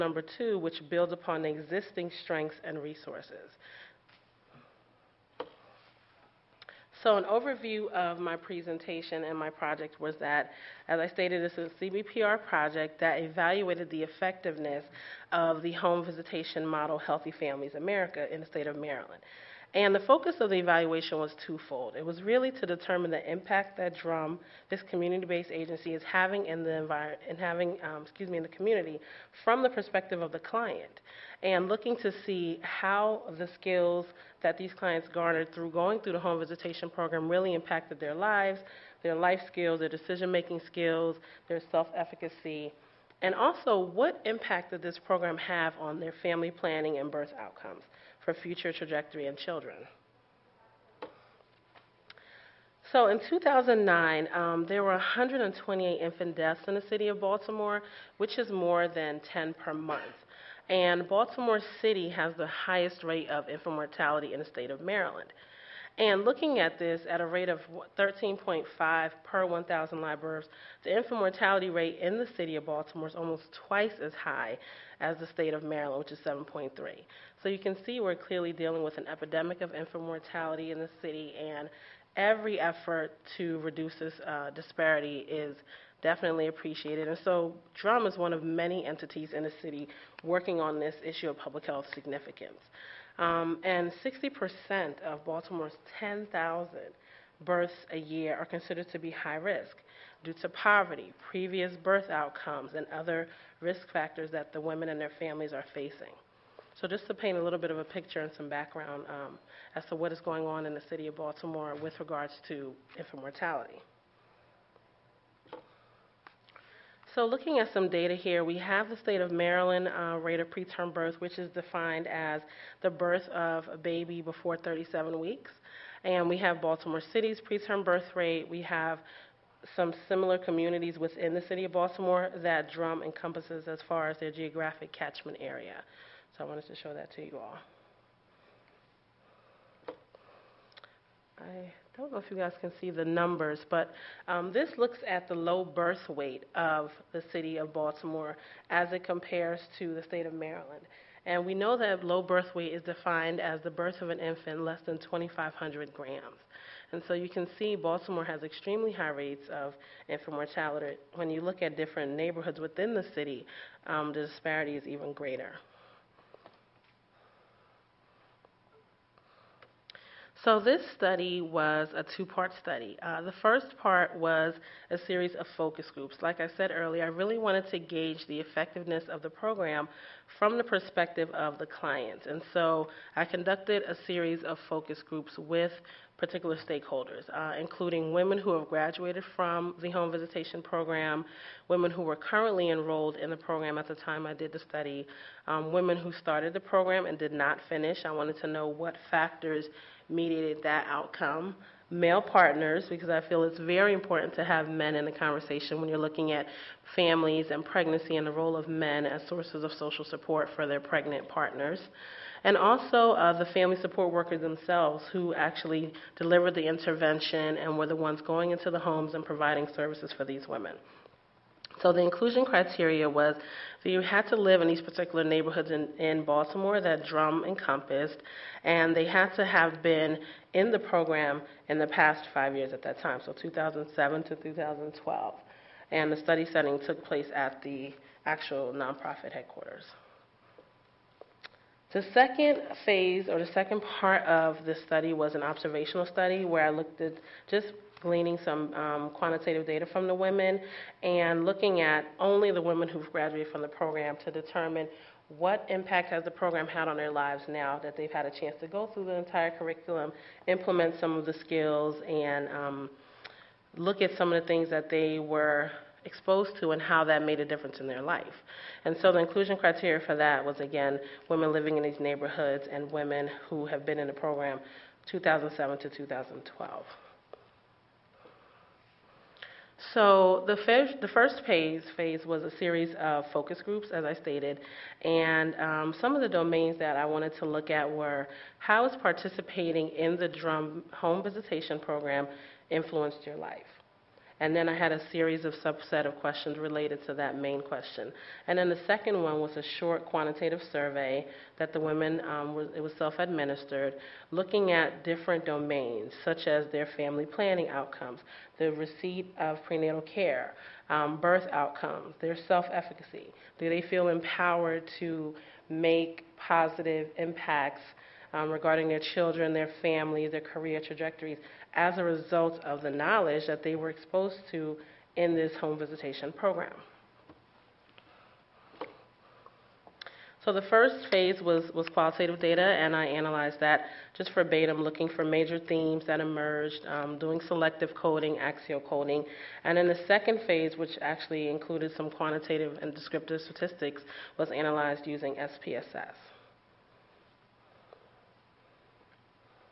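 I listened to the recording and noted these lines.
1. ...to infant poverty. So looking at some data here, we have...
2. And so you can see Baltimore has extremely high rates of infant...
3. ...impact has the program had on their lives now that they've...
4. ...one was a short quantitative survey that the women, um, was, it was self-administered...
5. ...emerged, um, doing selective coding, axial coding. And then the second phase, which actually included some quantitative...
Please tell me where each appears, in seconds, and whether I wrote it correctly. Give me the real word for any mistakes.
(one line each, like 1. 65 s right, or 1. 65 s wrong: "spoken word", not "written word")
1. 112 s wrong: "mortality", not "poverty"
2. 156 s right
3. 255 s right
4. 299 s right
5. 336 s right.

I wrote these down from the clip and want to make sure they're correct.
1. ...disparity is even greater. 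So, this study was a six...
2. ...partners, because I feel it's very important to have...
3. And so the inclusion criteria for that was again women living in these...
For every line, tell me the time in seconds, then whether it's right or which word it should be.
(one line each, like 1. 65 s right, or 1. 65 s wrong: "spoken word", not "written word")
1. 164 s wrong: "two", not "six"
2. 202 s right
3. 268 s right.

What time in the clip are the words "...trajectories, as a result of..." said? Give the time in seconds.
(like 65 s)
320 s.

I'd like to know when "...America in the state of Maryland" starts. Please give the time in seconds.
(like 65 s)
17 s.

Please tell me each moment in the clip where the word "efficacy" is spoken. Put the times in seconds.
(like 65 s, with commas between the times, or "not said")
41 s, 312 s.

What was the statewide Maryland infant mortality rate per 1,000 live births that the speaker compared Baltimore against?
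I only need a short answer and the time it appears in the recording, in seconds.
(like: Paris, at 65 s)
7.3, at 76 s.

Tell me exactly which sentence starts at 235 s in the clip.
And the study setting took place at the actual nonprofit headquarters.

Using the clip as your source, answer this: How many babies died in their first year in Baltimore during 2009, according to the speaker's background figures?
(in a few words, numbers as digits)
128.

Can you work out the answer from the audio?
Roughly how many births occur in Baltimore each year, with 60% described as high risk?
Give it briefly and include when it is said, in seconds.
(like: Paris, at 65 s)
10,000, at 96 s.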